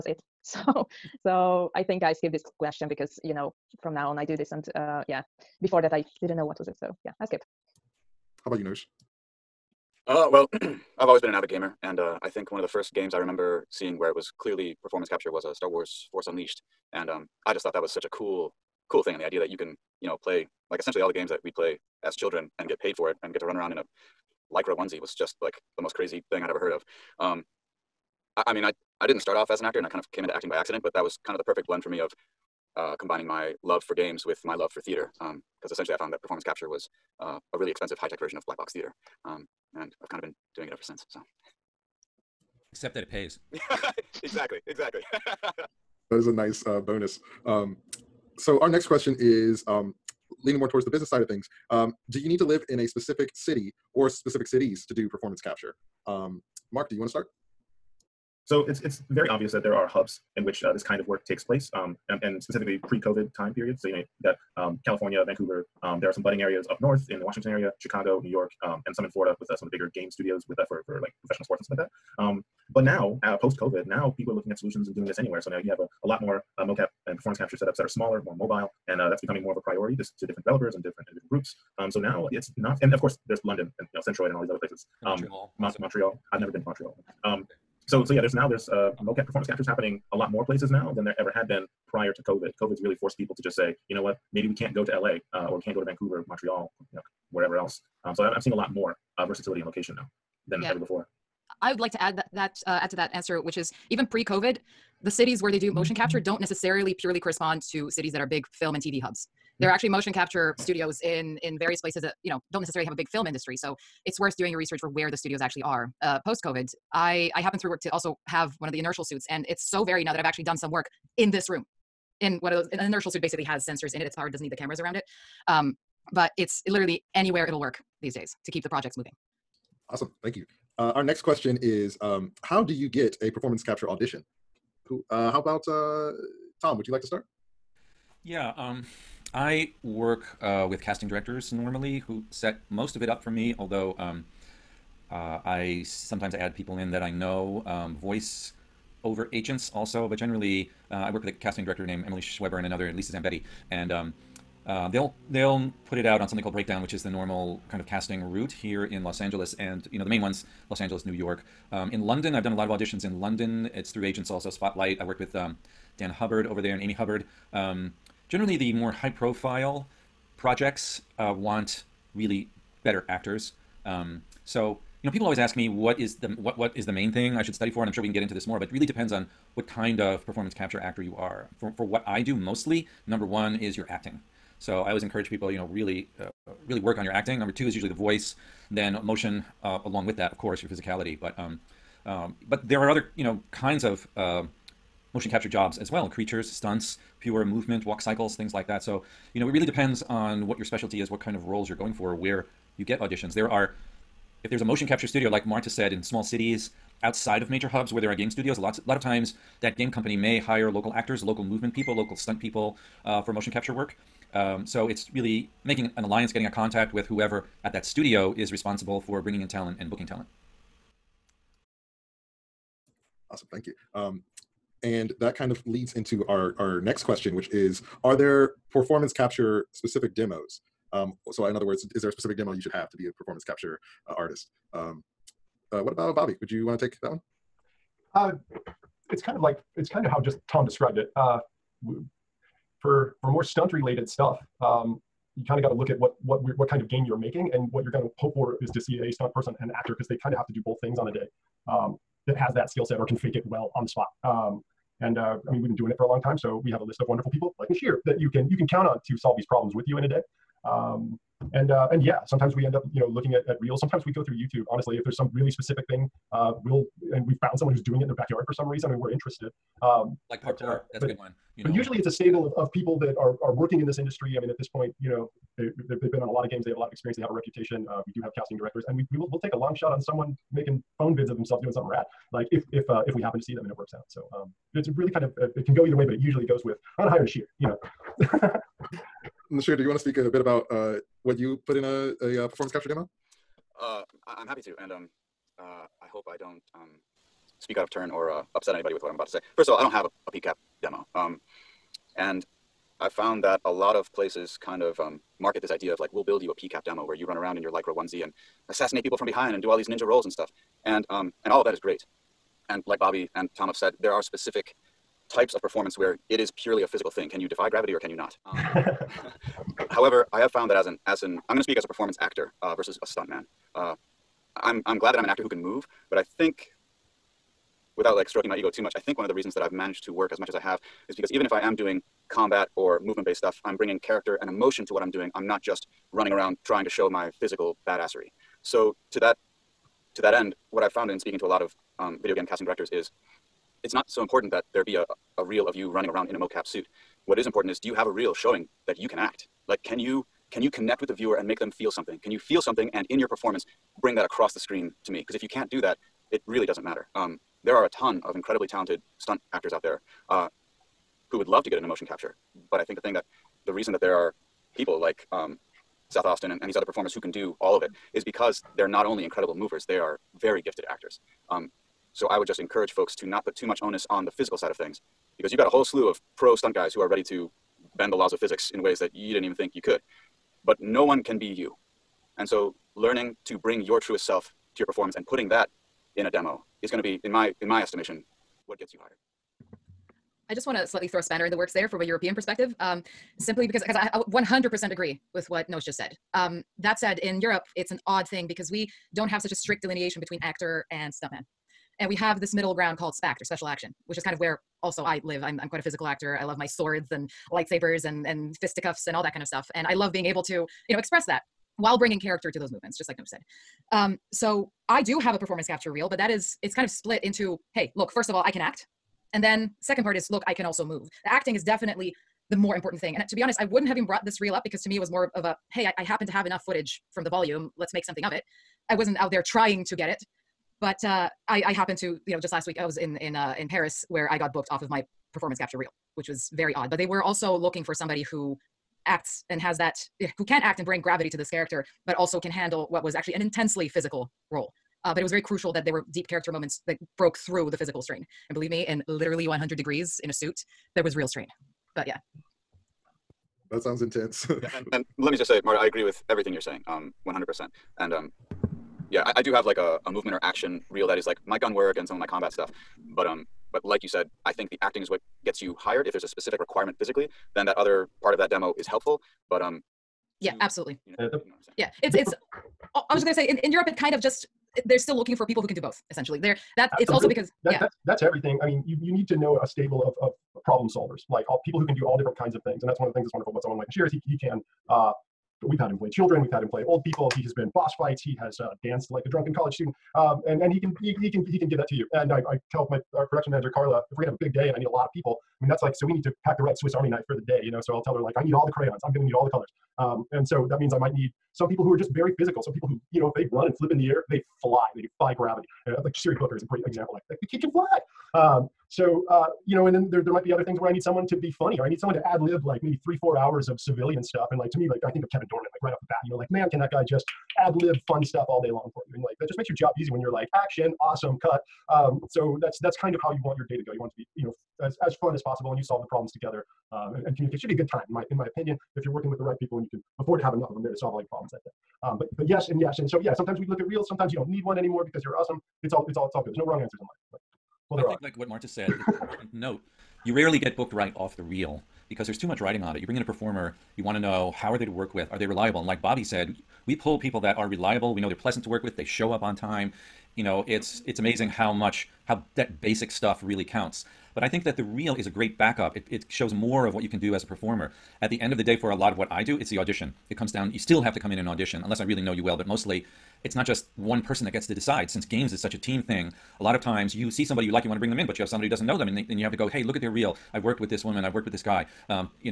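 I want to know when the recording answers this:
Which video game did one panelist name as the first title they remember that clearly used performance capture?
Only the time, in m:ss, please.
0:15.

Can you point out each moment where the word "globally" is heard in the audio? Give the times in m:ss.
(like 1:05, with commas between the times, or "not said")
not said.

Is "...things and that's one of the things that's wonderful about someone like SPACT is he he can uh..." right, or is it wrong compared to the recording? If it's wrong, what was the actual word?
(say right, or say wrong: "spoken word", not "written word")
wrong: "Noshir", not "SPACT".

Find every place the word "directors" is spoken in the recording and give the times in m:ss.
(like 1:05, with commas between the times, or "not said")
2:21, 2:31, 4:38, 5:42.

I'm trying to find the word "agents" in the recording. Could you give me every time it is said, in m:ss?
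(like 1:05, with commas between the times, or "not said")
2:29, 2:44.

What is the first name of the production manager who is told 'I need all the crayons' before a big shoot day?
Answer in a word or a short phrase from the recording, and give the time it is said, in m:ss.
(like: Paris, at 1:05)
Carla, at 8:13.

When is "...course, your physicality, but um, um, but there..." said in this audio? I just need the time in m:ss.
3:10.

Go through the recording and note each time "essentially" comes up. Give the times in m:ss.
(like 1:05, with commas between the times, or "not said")
0:20, 0:35, 7:56.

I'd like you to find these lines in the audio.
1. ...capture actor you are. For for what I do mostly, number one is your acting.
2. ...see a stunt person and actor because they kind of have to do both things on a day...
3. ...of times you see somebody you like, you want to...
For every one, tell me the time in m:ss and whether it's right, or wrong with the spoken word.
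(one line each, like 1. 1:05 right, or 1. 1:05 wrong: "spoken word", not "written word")
1. 3:00 right
2. 4:08 right
3. 9:26 right.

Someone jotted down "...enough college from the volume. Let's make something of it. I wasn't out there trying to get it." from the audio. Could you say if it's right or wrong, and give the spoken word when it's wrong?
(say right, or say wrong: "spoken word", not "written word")
wrong: "footage", not "college".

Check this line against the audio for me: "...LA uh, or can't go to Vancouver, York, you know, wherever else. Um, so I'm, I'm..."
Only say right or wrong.
wrong.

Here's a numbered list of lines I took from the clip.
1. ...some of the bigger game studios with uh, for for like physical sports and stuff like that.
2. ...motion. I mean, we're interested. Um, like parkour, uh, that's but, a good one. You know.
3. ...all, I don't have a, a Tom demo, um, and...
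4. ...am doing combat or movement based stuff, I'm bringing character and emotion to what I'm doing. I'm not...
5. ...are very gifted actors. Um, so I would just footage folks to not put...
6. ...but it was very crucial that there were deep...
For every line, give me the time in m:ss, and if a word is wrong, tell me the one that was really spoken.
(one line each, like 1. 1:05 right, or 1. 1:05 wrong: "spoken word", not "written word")
1. 1:09 wrong: "professional", not "physical"
2. 4:28 wrong: "reason", not "motion"
3. 4:59 wrong: "PCAP", not "Tom"
4. 5:31 right
5. 6:09 wrong: "encourage", not "footage"
6. 7:25 right.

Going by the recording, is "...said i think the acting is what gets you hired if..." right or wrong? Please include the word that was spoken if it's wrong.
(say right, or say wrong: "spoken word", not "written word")
right.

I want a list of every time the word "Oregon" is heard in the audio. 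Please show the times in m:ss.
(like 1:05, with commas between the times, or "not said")
not said.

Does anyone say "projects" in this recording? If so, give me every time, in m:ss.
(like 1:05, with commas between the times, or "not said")
2:08, 2:50.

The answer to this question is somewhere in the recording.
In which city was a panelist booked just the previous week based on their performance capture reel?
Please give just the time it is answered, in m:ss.
7:13.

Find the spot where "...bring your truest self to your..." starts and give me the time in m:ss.
6:23.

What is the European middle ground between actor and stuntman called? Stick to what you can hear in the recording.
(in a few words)
SPACT.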